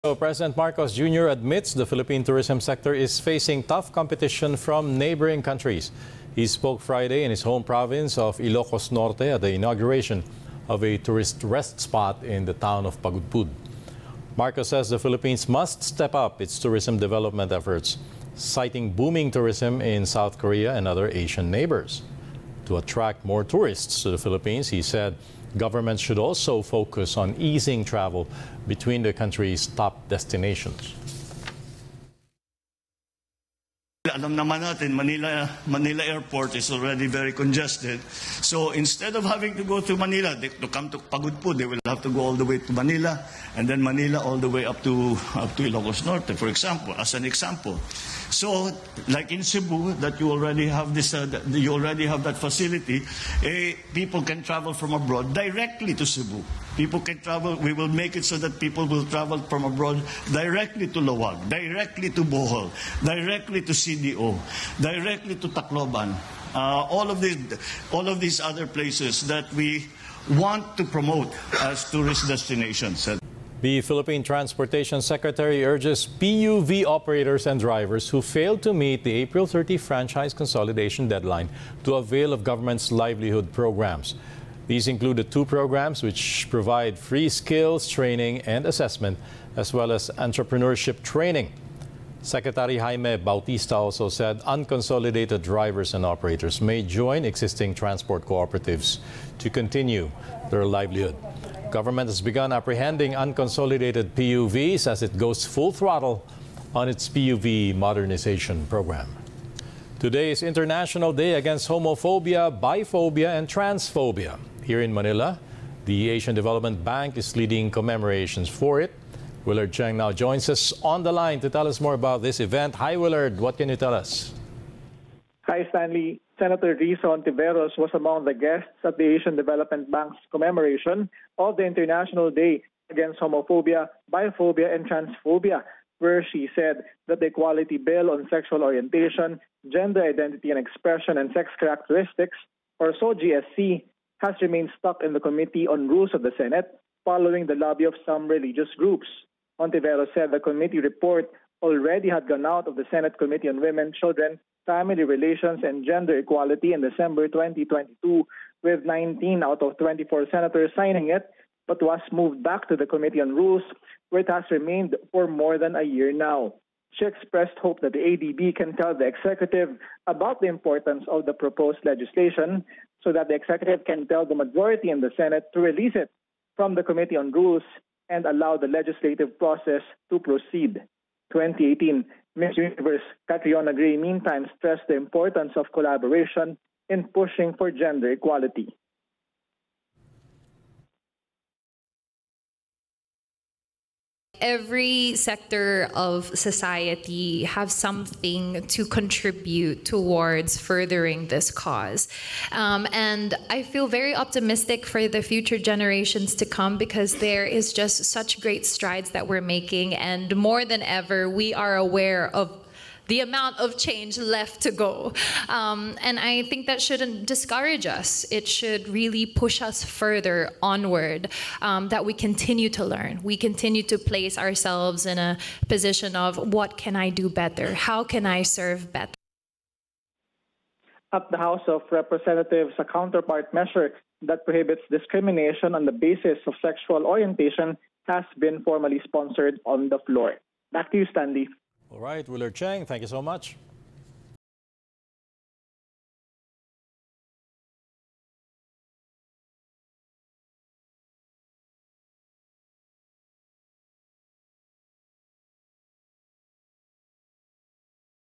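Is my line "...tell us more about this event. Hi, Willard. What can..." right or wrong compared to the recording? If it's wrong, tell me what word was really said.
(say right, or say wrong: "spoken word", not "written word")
right.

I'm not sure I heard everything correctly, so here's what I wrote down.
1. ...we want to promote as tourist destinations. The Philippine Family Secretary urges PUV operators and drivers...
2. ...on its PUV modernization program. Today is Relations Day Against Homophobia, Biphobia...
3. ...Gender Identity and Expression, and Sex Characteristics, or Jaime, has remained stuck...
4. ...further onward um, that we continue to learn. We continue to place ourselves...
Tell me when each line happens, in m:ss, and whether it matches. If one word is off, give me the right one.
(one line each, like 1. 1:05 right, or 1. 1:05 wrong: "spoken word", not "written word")
1. 1:09 wrong: "Transportation", not "Family"
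2. 1:46 wrong: "International", not "Relations"
3. 2:19 wrong: "SOGIESC", not "Jaime"
4. 3:39 right.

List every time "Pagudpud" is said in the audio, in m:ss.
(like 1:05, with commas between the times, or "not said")
0:13, 0:40.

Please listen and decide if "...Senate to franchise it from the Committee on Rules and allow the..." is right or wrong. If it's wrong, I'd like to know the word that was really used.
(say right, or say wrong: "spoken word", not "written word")
wrong: "release", not "franchise".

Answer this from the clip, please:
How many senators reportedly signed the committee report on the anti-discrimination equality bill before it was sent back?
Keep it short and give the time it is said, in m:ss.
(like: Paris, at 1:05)
19, at 2:38.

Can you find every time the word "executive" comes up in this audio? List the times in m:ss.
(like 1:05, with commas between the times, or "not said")
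2:49, 2:53.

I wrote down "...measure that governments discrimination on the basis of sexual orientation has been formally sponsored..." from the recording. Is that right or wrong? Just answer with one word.
wrong.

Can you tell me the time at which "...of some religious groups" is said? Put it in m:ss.
2:27.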